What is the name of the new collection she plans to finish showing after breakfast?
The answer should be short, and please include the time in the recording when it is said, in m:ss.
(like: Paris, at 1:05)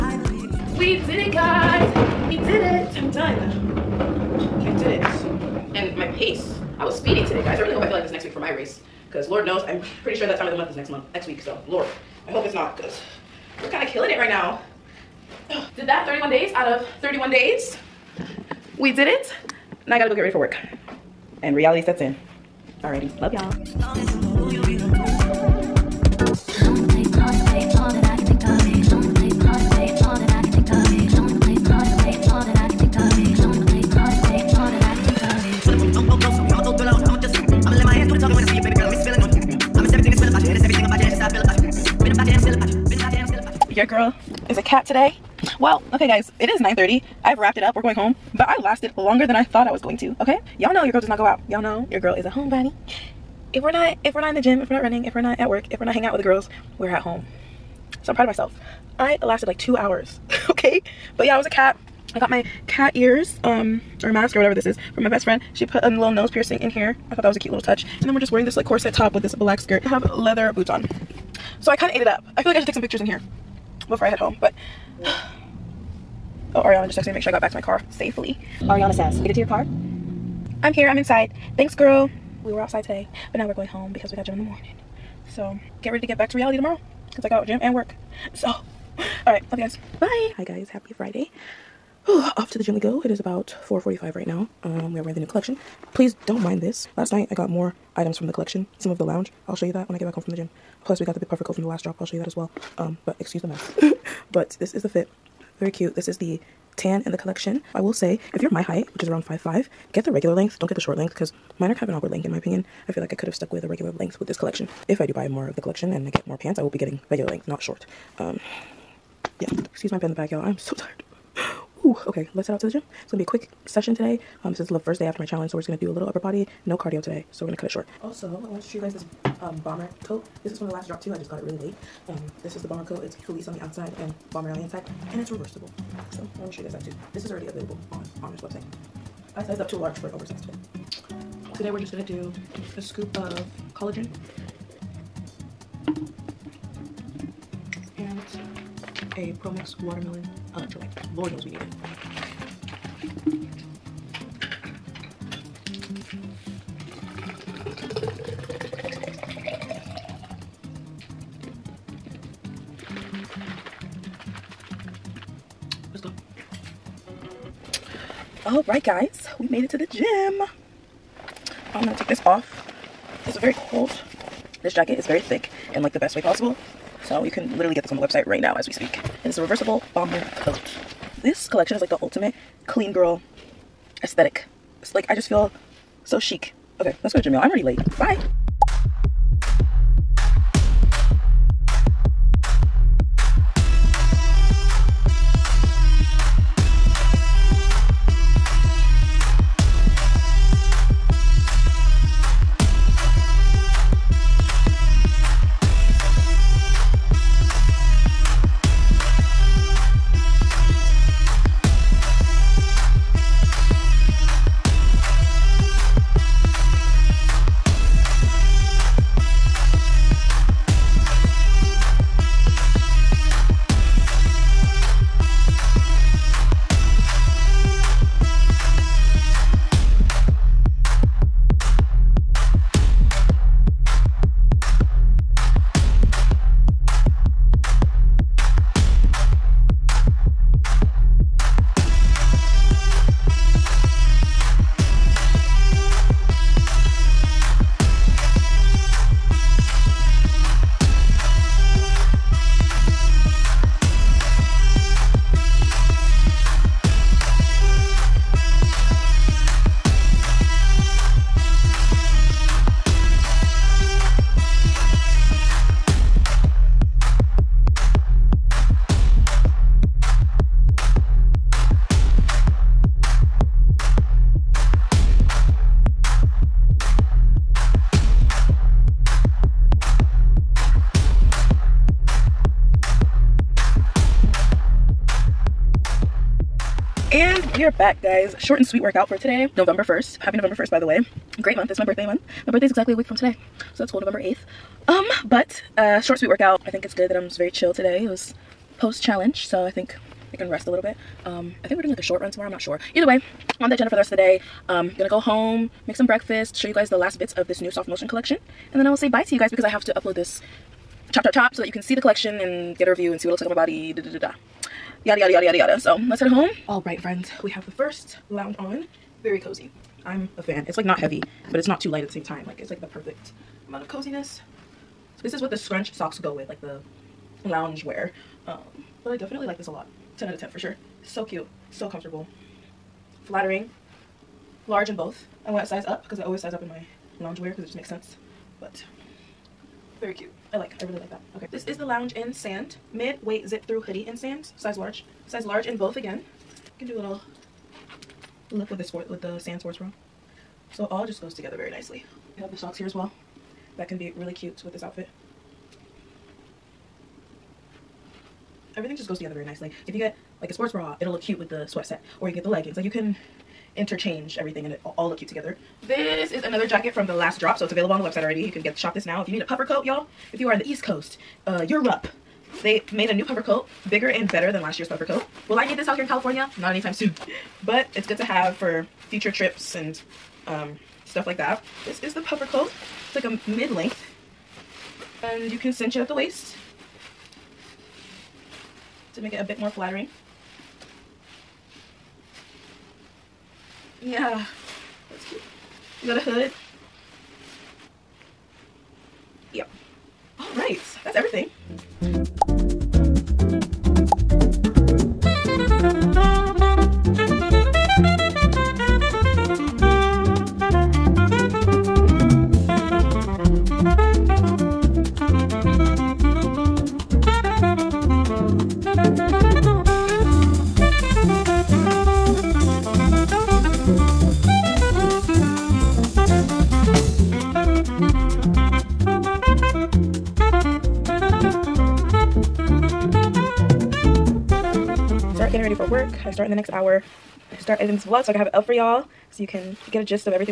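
Soft Motion, at 5:07.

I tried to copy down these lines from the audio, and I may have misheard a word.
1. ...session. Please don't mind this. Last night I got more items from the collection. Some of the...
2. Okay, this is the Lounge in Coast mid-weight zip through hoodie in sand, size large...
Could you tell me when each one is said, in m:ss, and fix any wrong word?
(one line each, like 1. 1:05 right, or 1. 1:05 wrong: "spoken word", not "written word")
1. 1:35 wrong: "collection", not "session"
2. 5:41 wrong: "Sand", not "Coast".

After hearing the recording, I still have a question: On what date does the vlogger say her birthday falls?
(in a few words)
November 8.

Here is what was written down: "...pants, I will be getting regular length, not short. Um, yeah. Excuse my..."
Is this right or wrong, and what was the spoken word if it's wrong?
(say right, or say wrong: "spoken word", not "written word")
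right.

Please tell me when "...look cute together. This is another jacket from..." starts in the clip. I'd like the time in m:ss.
6:05.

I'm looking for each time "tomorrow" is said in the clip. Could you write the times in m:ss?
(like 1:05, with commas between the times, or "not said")
1:26, 5:02.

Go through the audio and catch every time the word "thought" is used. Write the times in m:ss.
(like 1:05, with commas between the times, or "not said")
0:49, 1:07.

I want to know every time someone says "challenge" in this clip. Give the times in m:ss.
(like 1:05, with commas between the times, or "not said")
2:05, 4:59.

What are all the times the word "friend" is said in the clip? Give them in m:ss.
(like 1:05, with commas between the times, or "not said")
1:05, 5:16.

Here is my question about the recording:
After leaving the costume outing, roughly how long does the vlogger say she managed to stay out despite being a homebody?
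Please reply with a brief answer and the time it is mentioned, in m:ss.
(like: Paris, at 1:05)
2 hours, at 0:59.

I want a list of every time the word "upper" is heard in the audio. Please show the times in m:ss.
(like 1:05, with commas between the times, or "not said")
2:06.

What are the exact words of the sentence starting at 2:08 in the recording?
Also, I wanted to show you guys this um, bomber coat.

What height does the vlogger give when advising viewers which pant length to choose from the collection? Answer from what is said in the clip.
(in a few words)
5'5".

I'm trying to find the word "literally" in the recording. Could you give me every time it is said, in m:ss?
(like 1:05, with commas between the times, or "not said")
2:57.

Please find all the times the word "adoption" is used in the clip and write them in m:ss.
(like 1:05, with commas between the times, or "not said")
not said.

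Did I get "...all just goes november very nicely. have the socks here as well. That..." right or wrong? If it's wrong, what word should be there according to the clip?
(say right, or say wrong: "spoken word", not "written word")
wrong: "together", not "november".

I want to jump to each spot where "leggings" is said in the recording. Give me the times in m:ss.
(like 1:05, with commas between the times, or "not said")
6:02.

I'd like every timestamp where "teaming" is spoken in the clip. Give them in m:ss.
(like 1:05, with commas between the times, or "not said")
not said.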